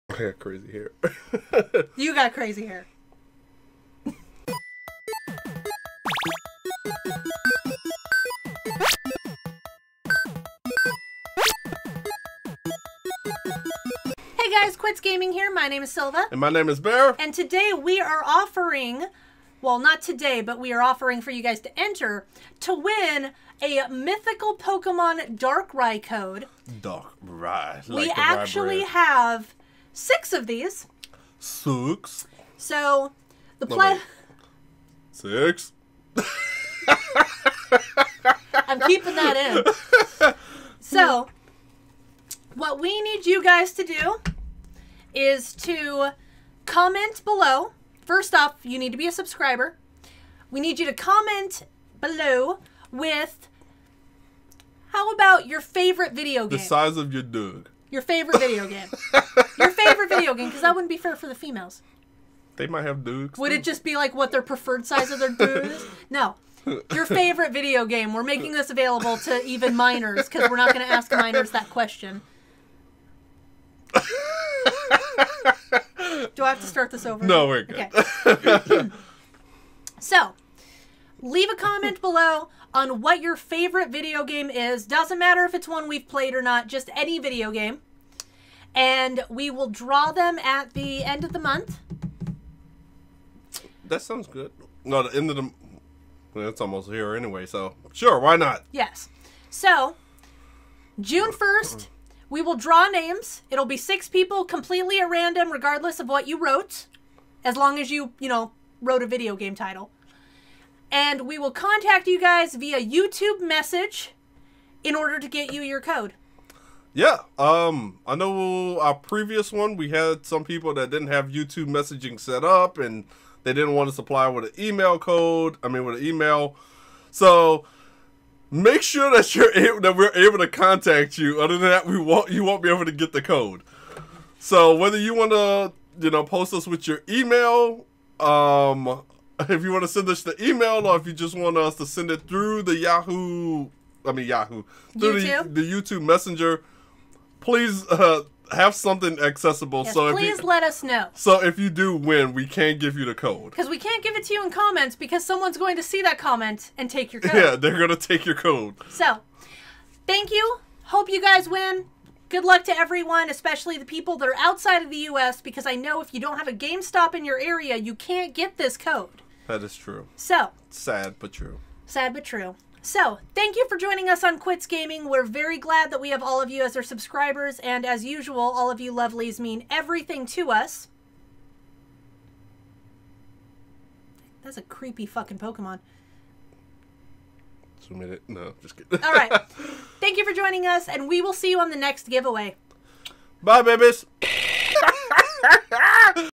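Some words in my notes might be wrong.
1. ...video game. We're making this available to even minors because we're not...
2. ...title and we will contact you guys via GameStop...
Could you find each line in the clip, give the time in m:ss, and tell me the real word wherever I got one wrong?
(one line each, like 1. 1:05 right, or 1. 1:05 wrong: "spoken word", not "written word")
1. 1:07 right
2. 1:49 wrong: "YouTube", not "GameStop".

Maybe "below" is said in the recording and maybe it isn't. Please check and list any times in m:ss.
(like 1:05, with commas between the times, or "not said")
0:47, 0:51, 1:22.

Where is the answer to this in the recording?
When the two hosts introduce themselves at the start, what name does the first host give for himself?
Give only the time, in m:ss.
0:15.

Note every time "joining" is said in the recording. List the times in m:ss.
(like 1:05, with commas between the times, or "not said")
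2:53, 3:10.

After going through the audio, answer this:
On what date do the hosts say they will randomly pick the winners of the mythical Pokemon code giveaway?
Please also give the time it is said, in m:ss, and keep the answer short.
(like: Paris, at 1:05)
June 1, at 1:41.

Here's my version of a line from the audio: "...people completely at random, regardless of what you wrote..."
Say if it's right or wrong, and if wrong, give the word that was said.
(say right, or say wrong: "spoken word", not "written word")
right.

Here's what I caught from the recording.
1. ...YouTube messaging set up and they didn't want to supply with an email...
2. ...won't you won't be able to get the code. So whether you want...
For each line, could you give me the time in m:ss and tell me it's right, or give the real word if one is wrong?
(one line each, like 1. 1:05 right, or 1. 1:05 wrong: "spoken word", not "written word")
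1. 2:01 right
2. 2:11 right.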